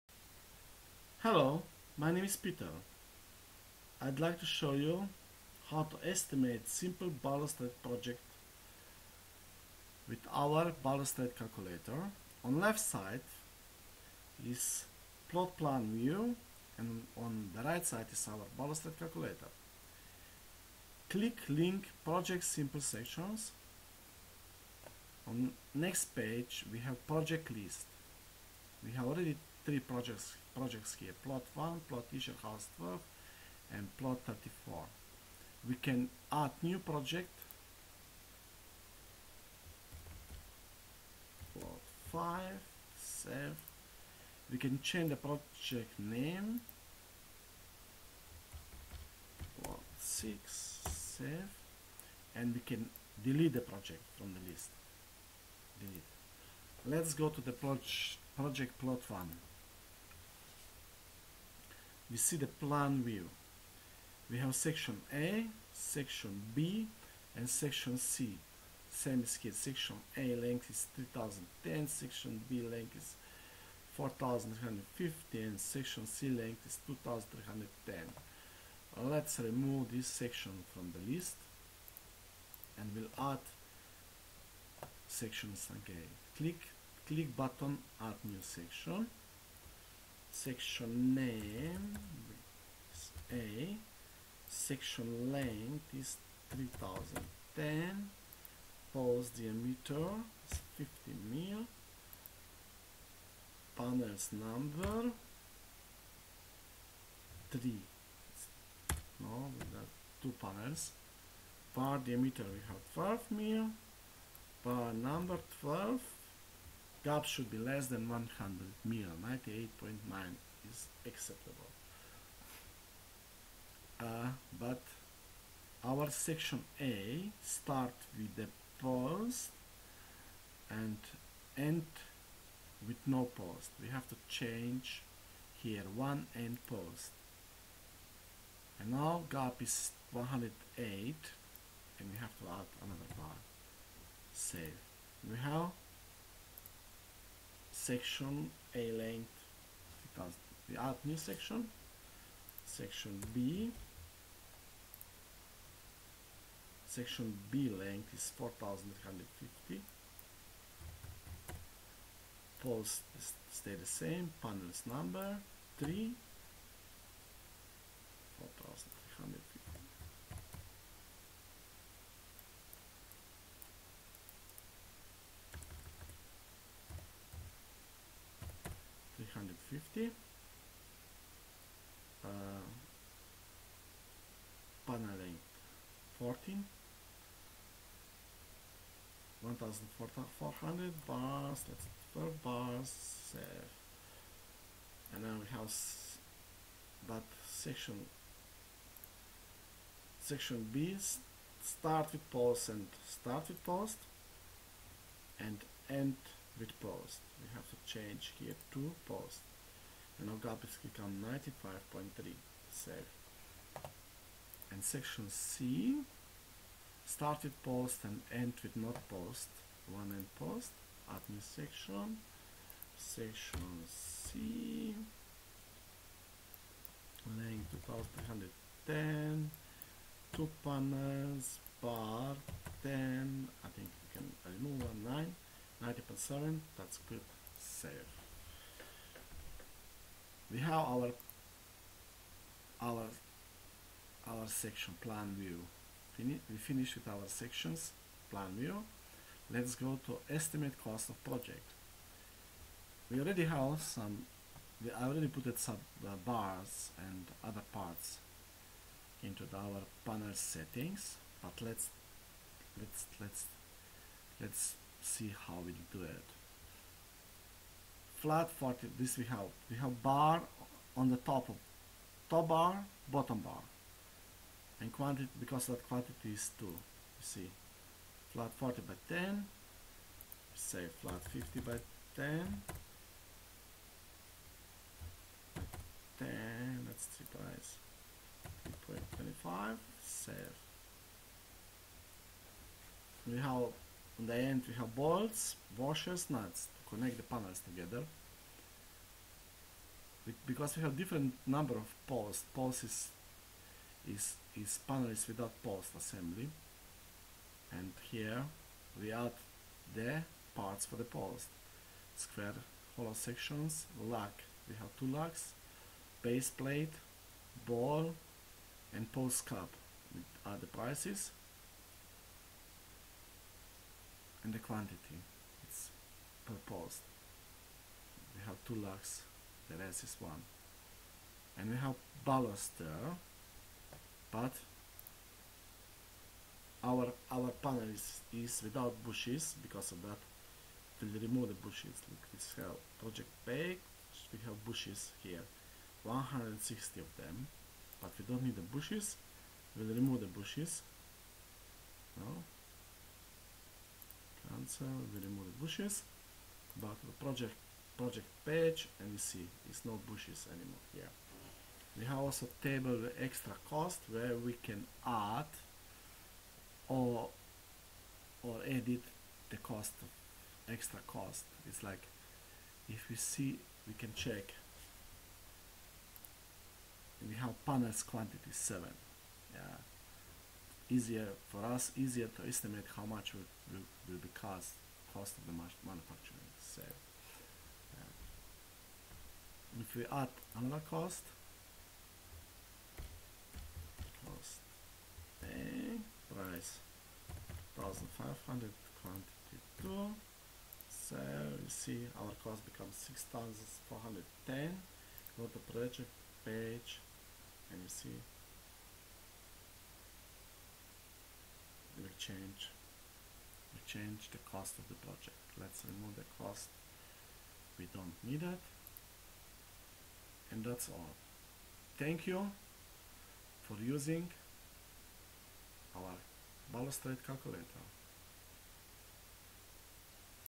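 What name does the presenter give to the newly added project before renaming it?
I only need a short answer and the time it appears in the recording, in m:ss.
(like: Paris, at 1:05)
plot 5, at 0:41.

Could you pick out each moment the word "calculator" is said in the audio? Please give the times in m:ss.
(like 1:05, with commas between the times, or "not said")
0:11, 0:18, 7:07.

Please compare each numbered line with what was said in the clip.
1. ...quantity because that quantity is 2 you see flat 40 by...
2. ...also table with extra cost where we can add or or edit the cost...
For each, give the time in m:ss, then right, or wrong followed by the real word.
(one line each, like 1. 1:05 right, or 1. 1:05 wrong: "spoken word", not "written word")
1. 4:34 right
2. 6:02 right.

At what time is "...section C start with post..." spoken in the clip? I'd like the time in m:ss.
3:34.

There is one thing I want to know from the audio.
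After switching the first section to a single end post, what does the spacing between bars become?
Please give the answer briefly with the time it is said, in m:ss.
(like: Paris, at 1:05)
108, at 2:20.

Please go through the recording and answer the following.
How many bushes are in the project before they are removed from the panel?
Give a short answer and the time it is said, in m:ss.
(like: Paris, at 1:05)
160, at 5:46.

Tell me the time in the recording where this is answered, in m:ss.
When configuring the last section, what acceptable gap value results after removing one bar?
3:56.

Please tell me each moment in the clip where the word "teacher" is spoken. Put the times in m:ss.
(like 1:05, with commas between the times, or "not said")
0:32.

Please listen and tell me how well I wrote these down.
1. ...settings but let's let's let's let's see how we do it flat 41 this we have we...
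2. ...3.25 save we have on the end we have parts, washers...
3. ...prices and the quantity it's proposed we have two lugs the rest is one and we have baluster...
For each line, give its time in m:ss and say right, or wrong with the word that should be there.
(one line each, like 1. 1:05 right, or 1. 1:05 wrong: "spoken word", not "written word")
1. 4:20 wrong: "40", not "41"
2. 4:48 wrong: "bolts", not "parts"
3. 5:20 right.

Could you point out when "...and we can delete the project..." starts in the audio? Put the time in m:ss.
0:52.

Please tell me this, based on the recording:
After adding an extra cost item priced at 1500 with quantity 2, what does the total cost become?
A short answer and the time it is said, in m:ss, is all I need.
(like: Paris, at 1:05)
6410, at 6:43.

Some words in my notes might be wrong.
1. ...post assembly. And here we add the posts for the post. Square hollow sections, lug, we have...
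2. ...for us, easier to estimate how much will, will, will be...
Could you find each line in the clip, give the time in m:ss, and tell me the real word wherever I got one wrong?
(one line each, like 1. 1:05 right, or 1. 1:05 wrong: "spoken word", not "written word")
1. 5:05 wrong: "parts", not "posts"
2. 6:21 right.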